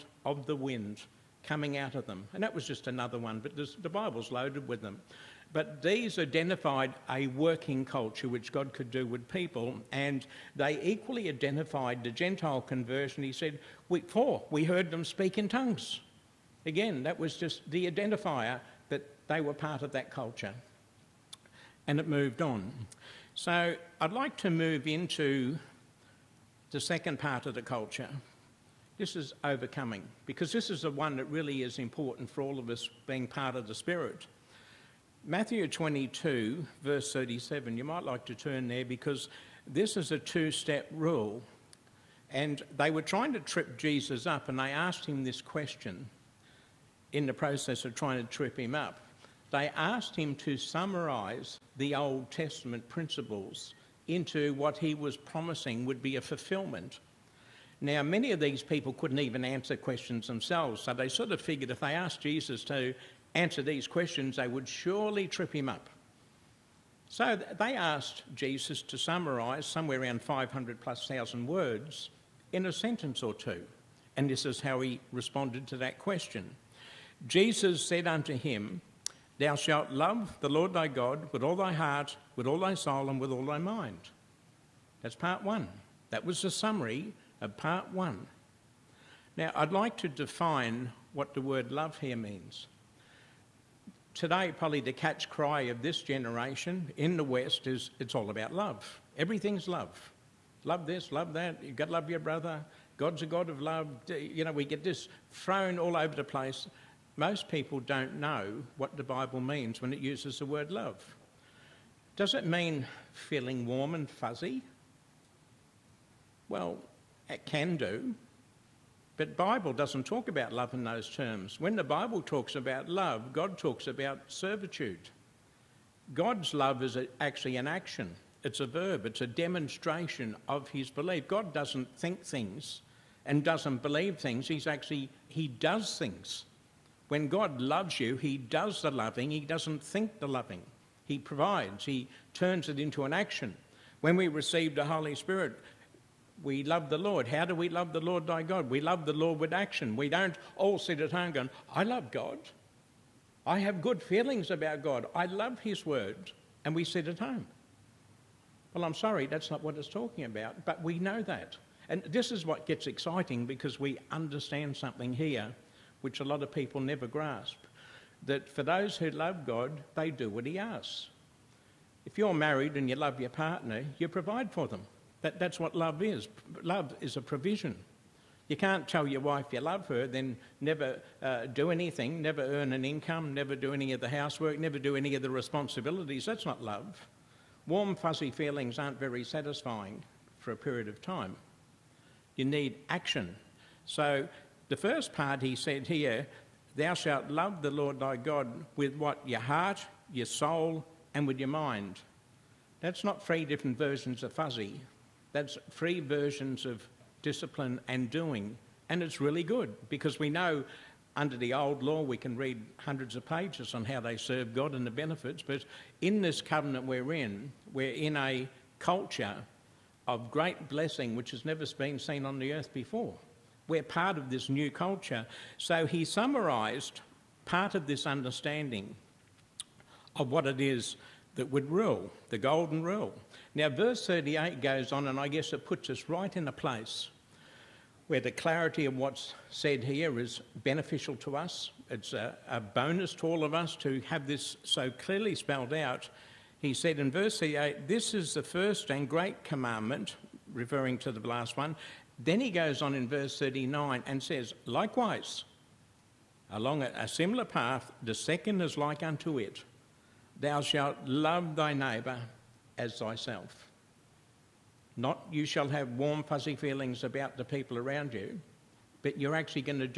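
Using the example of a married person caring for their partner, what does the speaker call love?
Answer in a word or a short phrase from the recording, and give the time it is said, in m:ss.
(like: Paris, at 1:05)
a provision, at 2:57.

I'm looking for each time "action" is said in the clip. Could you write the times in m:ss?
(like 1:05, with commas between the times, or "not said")
2:07, 2:23, 2:29, 3:12.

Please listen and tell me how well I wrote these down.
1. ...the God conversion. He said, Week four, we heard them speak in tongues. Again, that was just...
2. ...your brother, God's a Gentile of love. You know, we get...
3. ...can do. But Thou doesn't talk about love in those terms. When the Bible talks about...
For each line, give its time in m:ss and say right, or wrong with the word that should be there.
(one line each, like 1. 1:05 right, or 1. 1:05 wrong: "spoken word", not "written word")
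1. 0:12 wrong: "Gentile", not "God"
2. 1:42 wrong: "God", not "Gentile"
3. 1:57 wrong: "Bible", not "Thou".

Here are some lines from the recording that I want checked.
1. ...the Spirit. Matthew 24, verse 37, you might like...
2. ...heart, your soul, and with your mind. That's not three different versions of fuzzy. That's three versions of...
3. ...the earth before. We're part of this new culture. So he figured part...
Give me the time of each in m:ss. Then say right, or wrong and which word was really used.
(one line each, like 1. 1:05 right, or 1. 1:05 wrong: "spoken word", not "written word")
1. 0:33 wrong: "22", not "24"
2. 3:19 right
3. 3:42 wrong: "summarised", not "figured".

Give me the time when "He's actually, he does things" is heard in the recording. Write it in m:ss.
2:14.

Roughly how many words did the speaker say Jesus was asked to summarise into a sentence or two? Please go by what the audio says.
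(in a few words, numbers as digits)
500 plus thousand.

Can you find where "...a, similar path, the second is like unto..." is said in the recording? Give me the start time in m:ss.
4:16.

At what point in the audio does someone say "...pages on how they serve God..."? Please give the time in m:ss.
3:33.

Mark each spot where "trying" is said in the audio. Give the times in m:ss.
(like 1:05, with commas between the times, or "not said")
0:43, 0:47.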